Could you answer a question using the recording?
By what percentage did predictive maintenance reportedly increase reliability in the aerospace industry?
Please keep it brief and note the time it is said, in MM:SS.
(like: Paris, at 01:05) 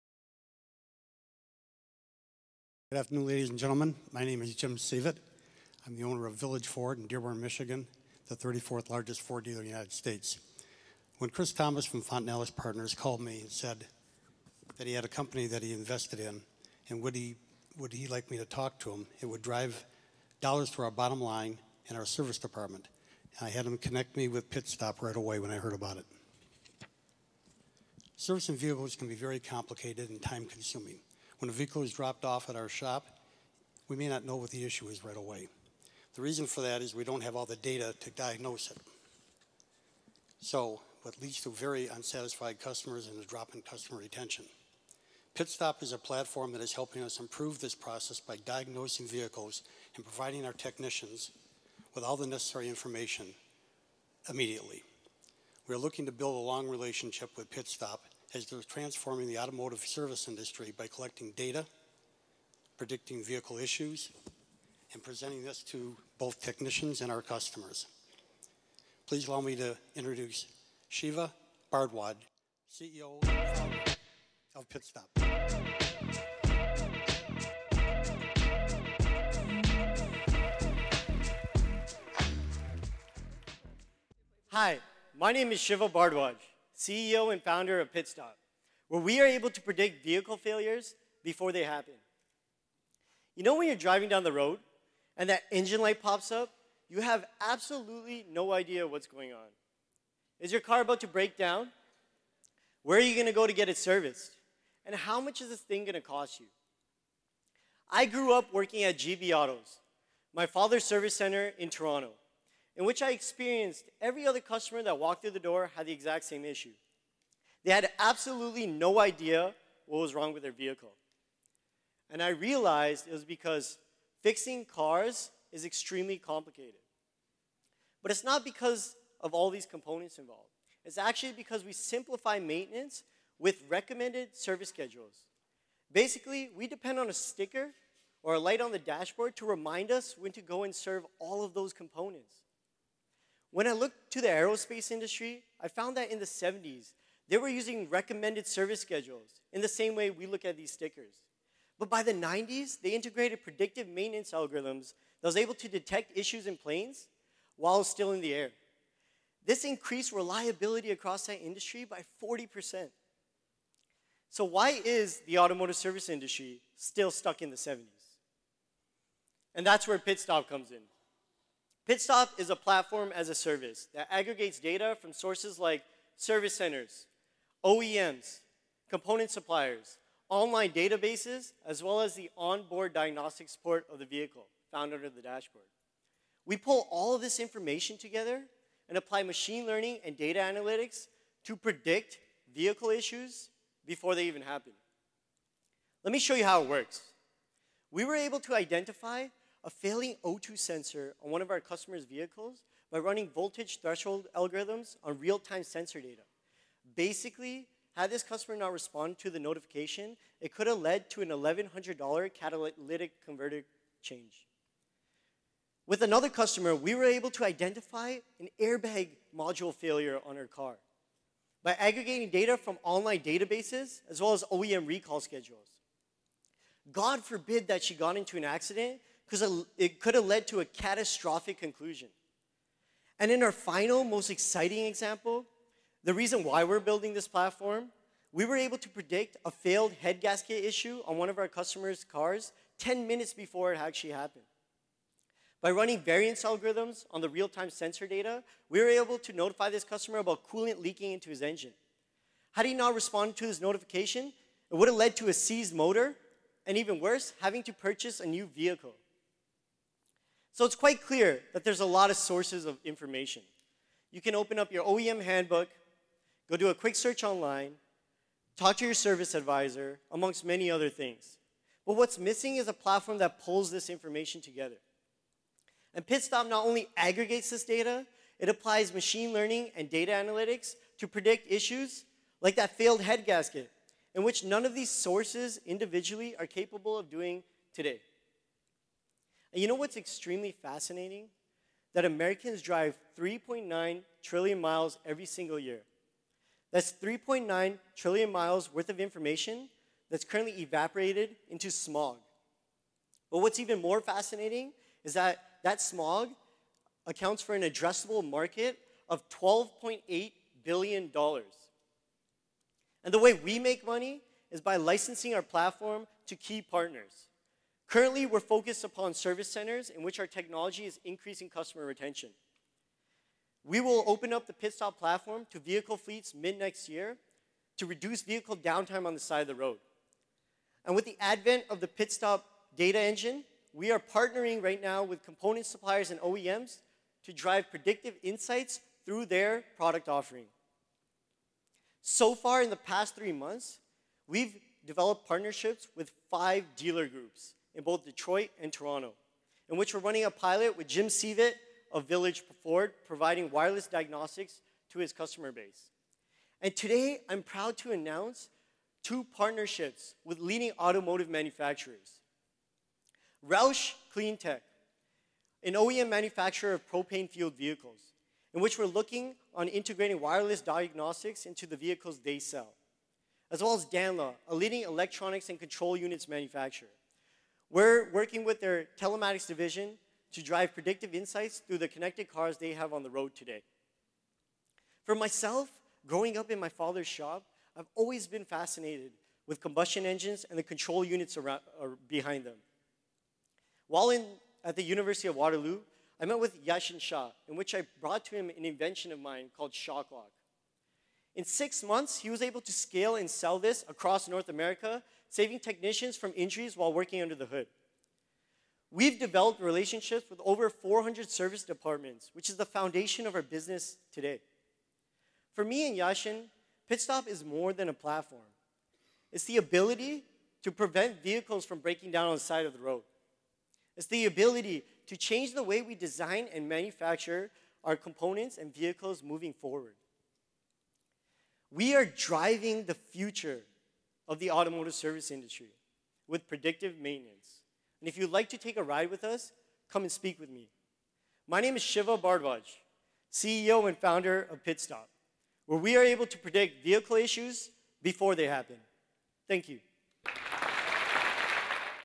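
40%, at 02:42.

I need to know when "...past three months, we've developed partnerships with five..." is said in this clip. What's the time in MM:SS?
05:42.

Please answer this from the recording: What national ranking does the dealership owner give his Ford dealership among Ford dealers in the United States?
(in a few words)
34th.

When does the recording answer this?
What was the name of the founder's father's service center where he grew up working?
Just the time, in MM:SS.
01:48.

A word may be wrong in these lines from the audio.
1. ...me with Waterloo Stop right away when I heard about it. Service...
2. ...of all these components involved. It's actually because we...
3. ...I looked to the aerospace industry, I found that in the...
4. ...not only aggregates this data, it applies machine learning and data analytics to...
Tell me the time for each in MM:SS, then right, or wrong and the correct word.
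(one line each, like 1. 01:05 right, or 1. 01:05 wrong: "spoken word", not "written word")
1. 00:24 wrong: "Pit", not "Waterloo"
2. 02:09 right
3. 02:23 right
4. 04:36 right.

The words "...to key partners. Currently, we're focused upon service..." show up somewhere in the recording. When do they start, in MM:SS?
05:16.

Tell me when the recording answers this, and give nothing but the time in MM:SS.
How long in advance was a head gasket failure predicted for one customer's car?
04:02.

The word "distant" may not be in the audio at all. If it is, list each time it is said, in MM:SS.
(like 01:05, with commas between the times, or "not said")
not said.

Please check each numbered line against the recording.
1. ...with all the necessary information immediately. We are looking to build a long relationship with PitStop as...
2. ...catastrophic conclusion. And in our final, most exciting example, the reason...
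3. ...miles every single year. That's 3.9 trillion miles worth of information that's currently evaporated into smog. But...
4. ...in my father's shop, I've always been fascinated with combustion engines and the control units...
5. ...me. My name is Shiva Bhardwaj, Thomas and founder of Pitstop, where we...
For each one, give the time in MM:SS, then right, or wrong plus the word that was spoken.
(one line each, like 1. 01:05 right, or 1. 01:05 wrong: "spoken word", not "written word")
1. 00:51 right
2. 03:50 right
3. 04:54 right
4. 06:26 right
5. 07:20 wrong: "CEO", not "Thomas".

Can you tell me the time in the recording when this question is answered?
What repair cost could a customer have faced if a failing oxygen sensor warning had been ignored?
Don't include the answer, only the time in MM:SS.
03:31.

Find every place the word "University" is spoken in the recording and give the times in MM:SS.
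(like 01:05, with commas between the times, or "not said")
06:34.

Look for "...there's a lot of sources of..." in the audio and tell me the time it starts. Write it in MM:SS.
04:21.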